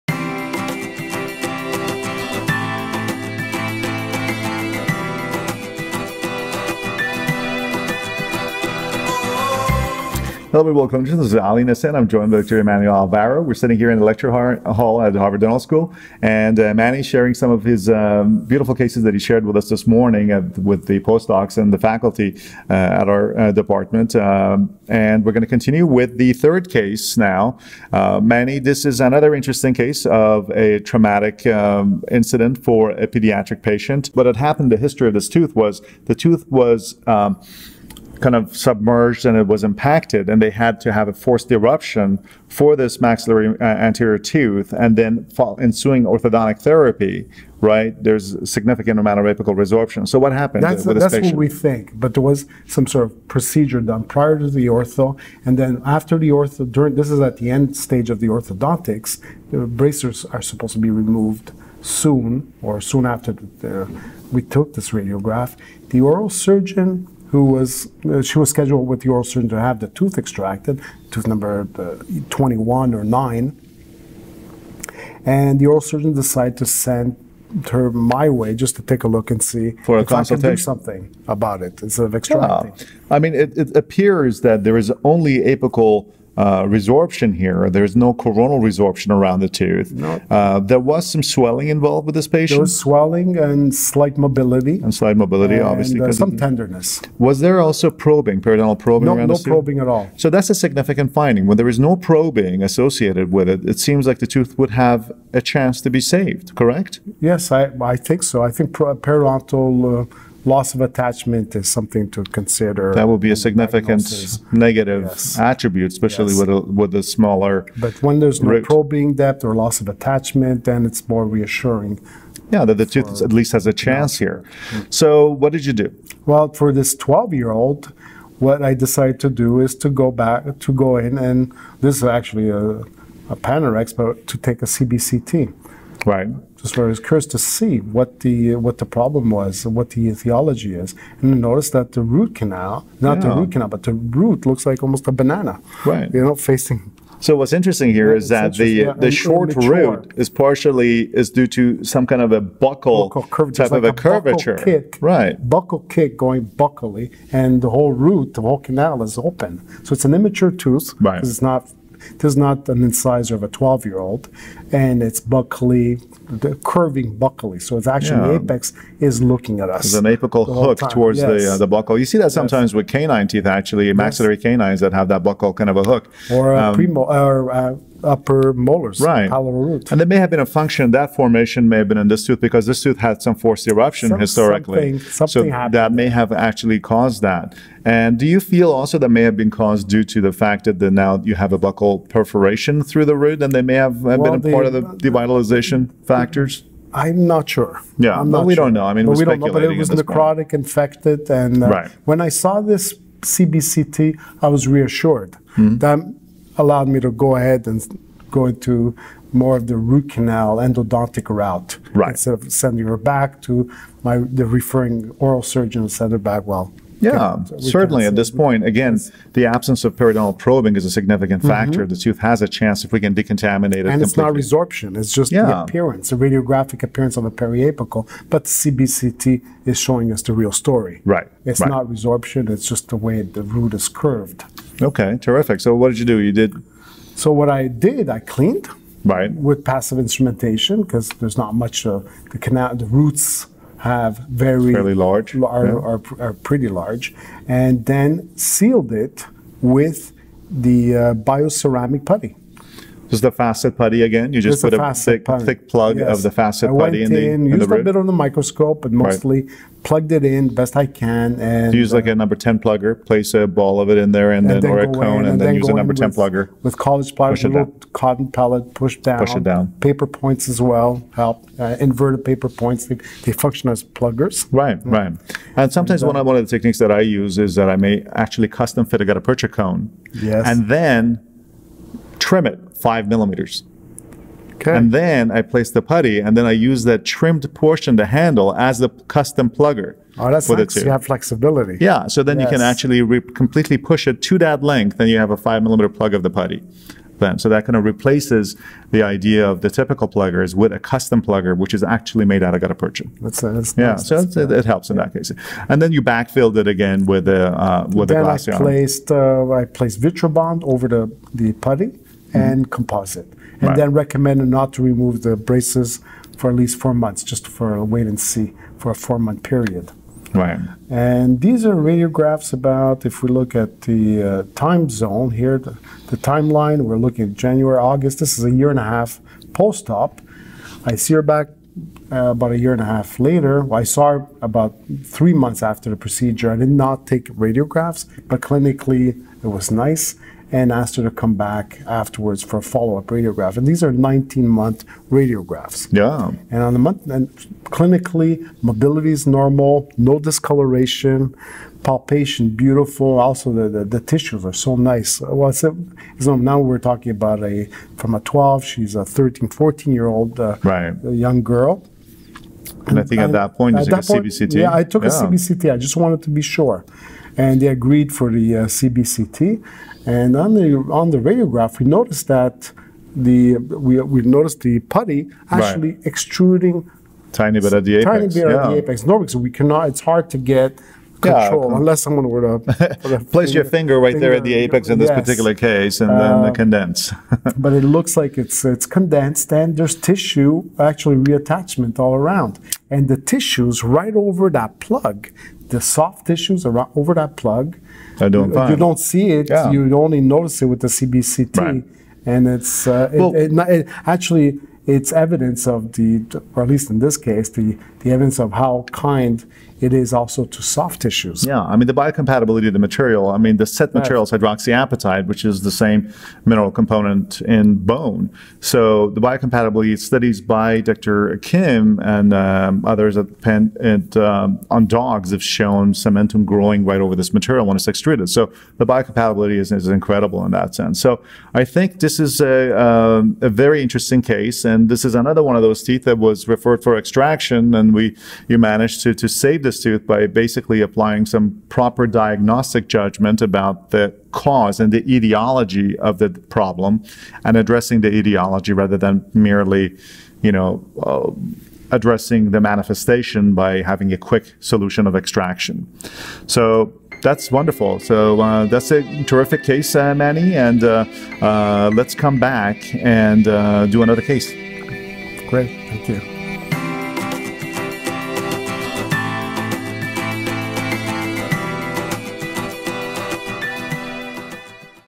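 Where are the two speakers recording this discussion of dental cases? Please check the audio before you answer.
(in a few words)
Harvard Dental School.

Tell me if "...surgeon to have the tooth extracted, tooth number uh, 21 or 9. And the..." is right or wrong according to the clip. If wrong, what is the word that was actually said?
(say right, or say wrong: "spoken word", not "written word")
right.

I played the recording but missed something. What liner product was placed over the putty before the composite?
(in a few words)
Vitrebond.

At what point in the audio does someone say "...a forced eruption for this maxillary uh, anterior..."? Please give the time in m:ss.
0:41.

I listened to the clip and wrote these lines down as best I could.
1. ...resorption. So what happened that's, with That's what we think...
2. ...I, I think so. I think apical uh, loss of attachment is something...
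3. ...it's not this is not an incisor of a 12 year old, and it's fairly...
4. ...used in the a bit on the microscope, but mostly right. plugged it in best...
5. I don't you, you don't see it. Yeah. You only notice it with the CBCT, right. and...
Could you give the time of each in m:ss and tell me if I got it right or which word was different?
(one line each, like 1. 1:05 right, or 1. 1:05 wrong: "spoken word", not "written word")
1. 0:49 right
2. 1:47 wrong: "periodontal", not "apical"
3. 2:41 wrong: "buccally", not "fairly"
4. 4:17 right
5. 6:38 right.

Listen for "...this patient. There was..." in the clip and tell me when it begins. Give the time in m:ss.
1:32.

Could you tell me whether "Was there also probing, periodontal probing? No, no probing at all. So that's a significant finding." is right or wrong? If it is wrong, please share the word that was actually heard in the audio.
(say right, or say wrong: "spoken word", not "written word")
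right.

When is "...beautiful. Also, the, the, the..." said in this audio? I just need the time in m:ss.
5:52.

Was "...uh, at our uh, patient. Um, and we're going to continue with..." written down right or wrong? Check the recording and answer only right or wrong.
wrong.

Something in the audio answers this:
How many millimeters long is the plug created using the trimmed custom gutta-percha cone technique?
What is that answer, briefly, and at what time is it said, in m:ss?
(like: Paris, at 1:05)
5, at 4:55.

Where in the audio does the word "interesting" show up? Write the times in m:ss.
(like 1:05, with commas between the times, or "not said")
0:29, 2:27, 7:13.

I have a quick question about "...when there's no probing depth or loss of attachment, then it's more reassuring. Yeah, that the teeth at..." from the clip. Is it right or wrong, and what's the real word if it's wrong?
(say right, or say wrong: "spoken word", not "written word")
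wrong: "tooth", not "teeth".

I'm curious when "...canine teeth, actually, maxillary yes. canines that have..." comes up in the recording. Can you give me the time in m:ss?
2:52.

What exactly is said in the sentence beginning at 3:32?
instead of sending her back to my the referring oral surgeon, send her back well.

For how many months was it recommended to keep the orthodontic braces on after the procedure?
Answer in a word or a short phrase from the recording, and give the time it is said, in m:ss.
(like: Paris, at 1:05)
4, at 5:16.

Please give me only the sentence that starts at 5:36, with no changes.
I did not take radiographs, but clinically it was nice and asked her to come back afterwards for a follow-up radiograph.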